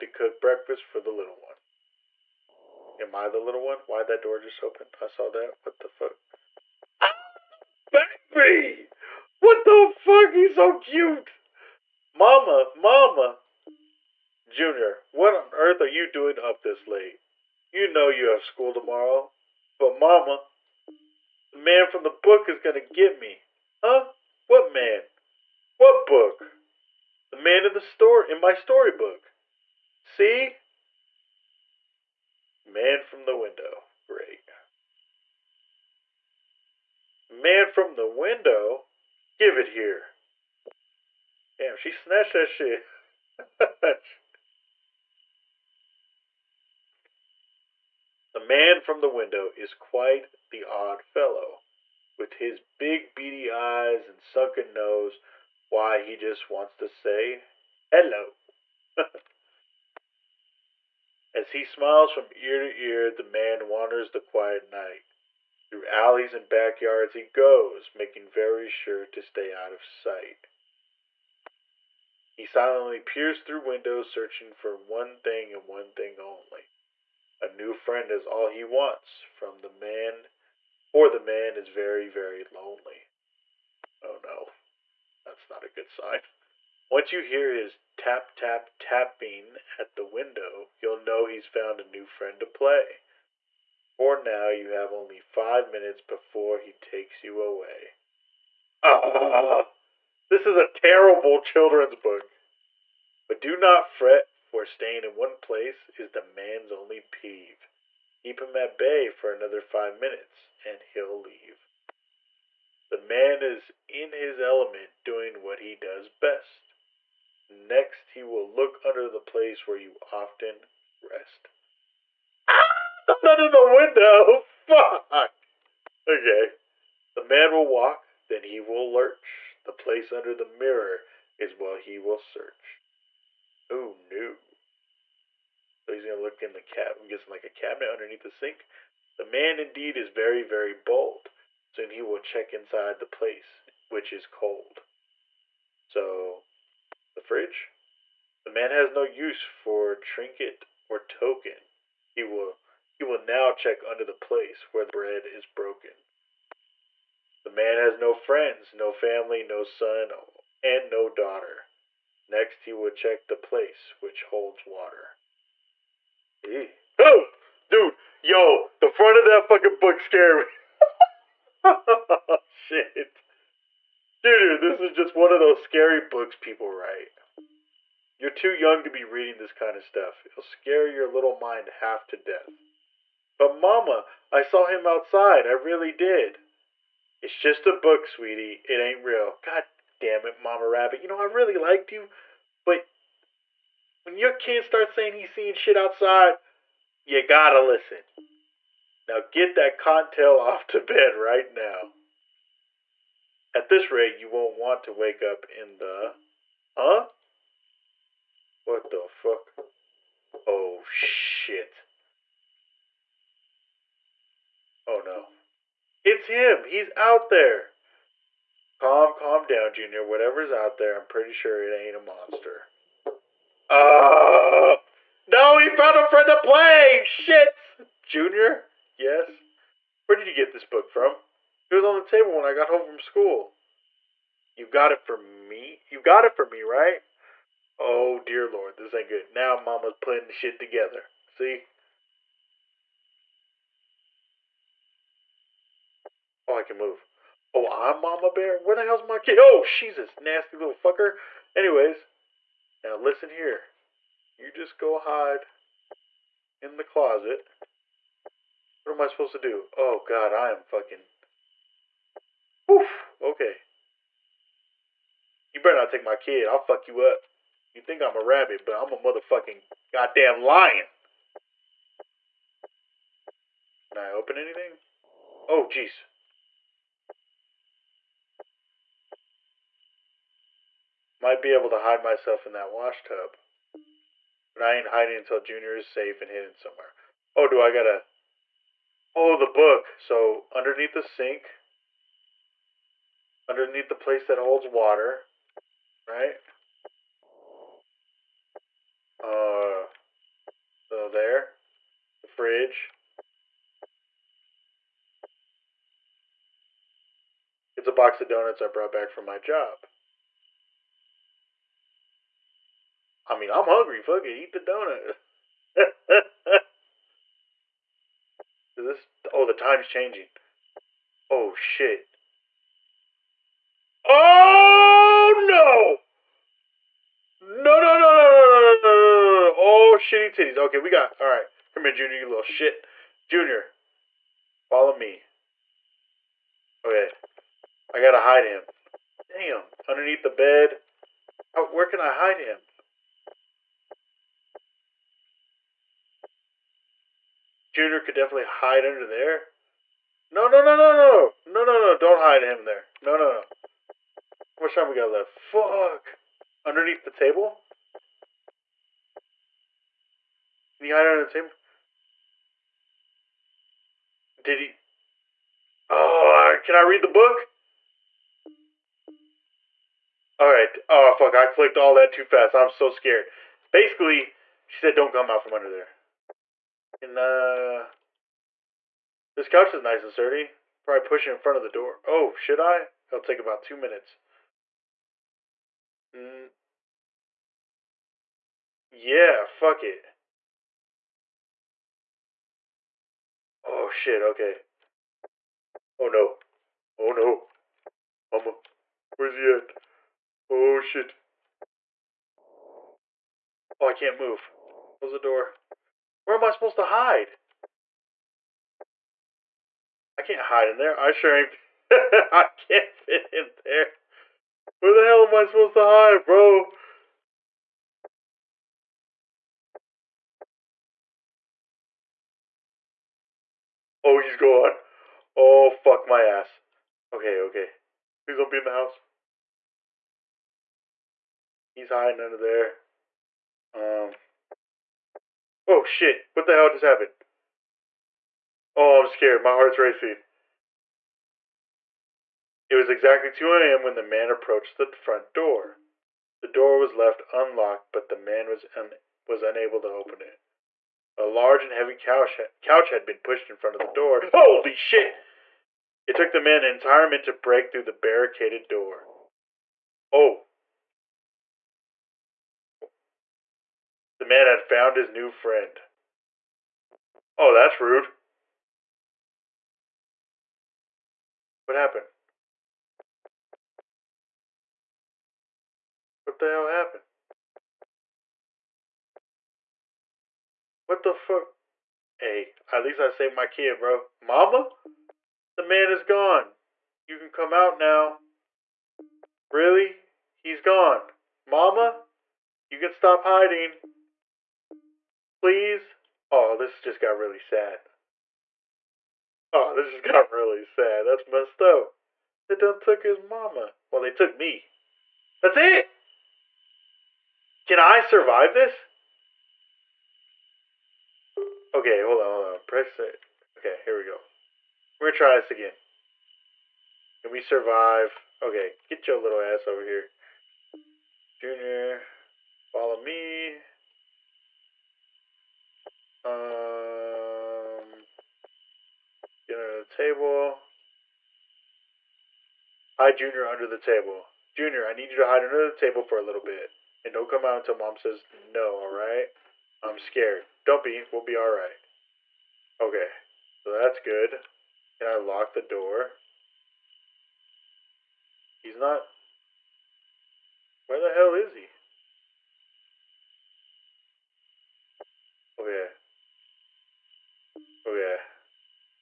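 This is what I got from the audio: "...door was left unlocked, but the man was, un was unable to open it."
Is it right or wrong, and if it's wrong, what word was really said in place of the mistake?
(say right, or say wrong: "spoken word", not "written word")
right.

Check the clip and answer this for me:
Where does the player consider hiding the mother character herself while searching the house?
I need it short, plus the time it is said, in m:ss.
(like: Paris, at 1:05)
Wash tub, at 4:42.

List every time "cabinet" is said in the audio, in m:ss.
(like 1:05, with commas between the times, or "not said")
2:17.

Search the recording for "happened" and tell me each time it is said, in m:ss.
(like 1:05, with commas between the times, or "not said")
7:16, 7:51, 7:56.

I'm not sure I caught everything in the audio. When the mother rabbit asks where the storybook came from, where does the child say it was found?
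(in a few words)
On the table.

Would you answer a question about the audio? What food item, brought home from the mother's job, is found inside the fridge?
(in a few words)
Donuts.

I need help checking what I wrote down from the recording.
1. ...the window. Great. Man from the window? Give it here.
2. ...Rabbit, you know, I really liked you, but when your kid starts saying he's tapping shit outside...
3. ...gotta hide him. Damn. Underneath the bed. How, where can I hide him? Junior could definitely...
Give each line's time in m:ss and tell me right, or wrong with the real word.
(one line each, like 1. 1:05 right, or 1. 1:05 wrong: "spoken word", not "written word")
1. 0:33 right
2. 3:10 wrong: "seeing", not "tapping"
3. 5:37 right.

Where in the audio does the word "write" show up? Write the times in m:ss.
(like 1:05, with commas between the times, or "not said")
2:56.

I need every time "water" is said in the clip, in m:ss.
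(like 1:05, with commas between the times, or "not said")
2:44, 4:54.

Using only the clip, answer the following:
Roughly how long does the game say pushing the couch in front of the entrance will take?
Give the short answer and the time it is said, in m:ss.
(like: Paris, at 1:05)
2 minutes, at 6:23.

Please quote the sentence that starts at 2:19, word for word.
The man indeed is very, very bold.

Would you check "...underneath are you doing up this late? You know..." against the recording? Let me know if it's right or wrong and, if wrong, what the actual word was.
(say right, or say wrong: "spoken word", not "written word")
wrong: "earth", not "underneath".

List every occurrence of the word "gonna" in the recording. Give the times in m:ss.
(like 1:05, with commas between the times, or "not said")
2:16, 8:35.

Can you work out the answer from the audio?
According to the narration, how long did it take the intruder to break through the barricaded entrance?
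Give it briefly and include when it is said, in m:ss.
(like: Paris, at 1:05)
1 minute, at 7:36.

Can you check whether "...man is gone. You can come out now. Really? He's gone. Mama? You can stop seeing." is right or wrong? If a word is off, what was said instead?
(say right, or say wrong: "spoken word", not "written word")
wrong: "hiding", not "seeing".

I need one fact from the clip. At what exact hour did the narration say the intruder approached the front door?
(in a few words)
2 a.m.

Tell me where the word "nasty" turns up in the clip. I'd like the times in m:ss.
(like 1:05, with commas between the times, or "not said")
4:10.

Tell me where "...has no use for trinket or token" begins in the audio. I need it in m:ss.
2:28.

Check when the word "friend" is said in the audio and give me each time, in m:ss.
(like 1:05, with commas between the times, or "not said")
1:17, 1:32, 2:38, 3:46, 7:45.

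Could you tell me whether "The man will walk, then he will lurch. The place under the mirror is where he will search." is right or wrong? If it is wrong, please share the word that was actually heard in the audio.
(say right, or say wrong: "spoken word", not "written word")
right.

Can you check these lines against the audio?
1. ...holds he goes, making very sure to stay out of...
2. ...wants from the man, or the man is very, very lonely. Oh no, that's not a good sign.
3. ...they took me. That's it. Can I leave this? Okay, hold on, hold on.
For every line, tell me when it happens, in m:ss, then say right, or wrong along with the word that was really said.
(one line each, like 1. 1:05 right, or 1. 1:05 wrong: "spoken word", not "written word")
1. 1:06 wrong: "backyards", not "holds"
2. 1:18 right
3. 8:24 wrong: "survive", not "leave".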